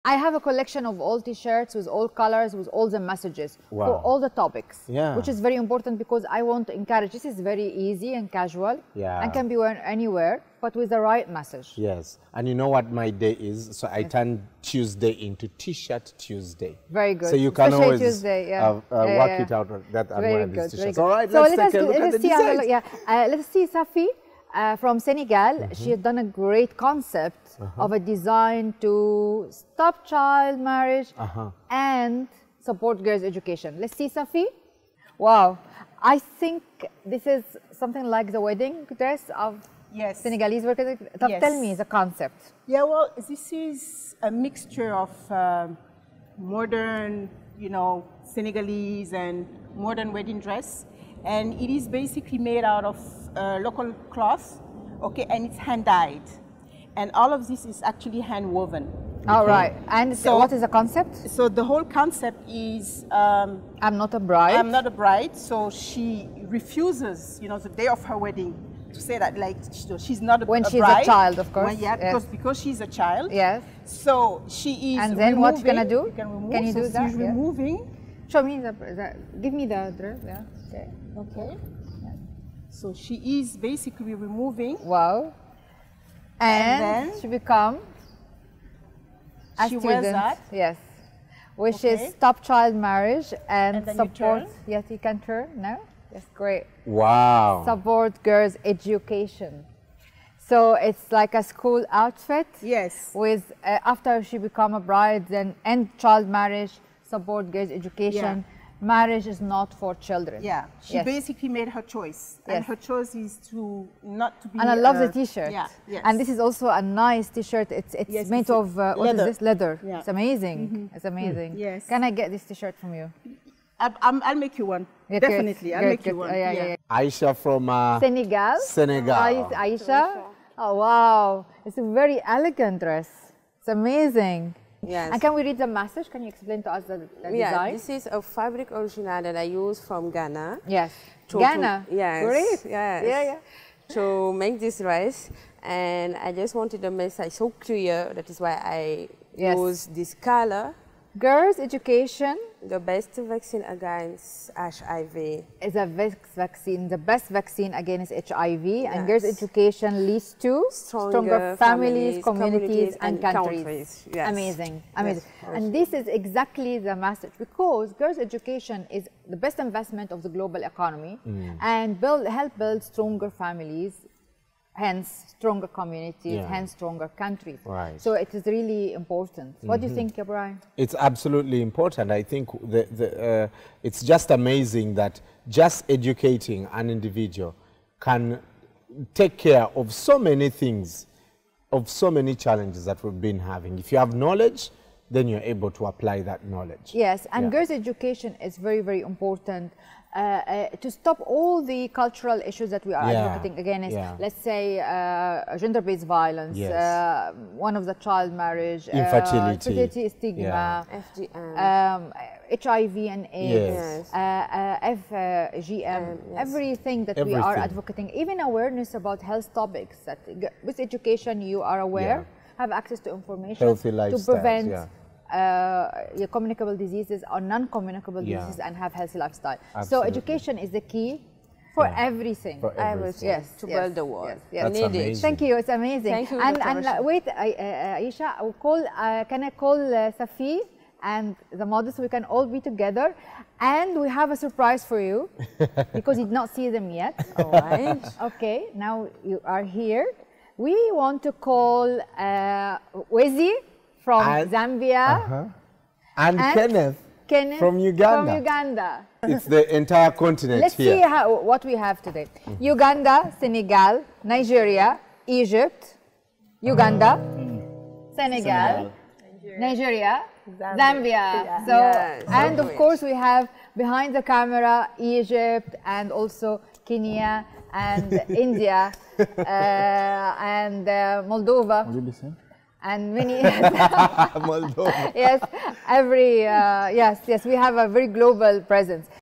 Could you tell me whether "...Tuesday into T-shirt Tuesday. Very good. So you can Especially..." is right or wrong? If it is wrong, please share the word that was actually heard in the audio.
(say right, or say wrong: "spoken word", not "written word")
right.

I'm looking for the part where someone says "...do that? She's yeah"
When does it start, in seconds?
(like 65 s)
76 s.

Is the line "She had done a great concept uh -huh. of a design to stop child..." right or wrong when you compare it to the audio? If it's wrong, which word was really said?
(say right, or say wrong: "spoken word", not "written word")
right.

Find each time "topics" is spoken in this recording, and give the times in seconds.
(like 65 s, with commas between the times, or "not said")
4 s, 219 s.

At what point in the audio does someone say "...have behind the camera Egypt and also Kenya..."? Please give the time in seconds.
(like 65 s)
273 s.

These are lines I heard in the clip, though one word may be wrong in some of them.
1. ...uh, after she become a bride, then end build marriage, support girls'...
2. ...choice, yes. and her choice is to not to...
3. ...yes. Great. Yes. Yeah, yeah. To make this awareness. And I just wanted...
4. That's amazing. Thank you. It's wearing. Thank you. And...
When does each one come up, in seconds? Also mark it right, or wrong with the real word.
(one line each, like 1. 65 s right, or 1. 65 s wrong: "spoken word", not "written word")
1. 103 s wrong: "child", not "build"
2. 111 s right
3. 141 s wrong: "dress", not "awareness"
4. 234 s wrong: "amazing", not "wearing".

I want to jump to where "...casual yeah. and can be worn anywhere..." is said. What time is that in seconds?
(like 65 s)
8 s.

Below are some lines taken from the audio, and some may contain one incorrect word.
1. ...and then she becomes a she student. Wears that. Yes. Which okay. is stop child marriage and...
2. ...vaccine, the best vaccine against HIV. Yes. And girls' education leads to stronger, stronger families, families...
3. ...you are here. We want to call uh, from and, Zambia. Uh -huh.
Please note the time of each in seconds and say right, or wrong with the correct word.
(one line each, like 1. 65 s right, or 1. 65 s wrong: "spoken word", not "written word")
1. 86 s right
2. 156 s right
3. 249 s right.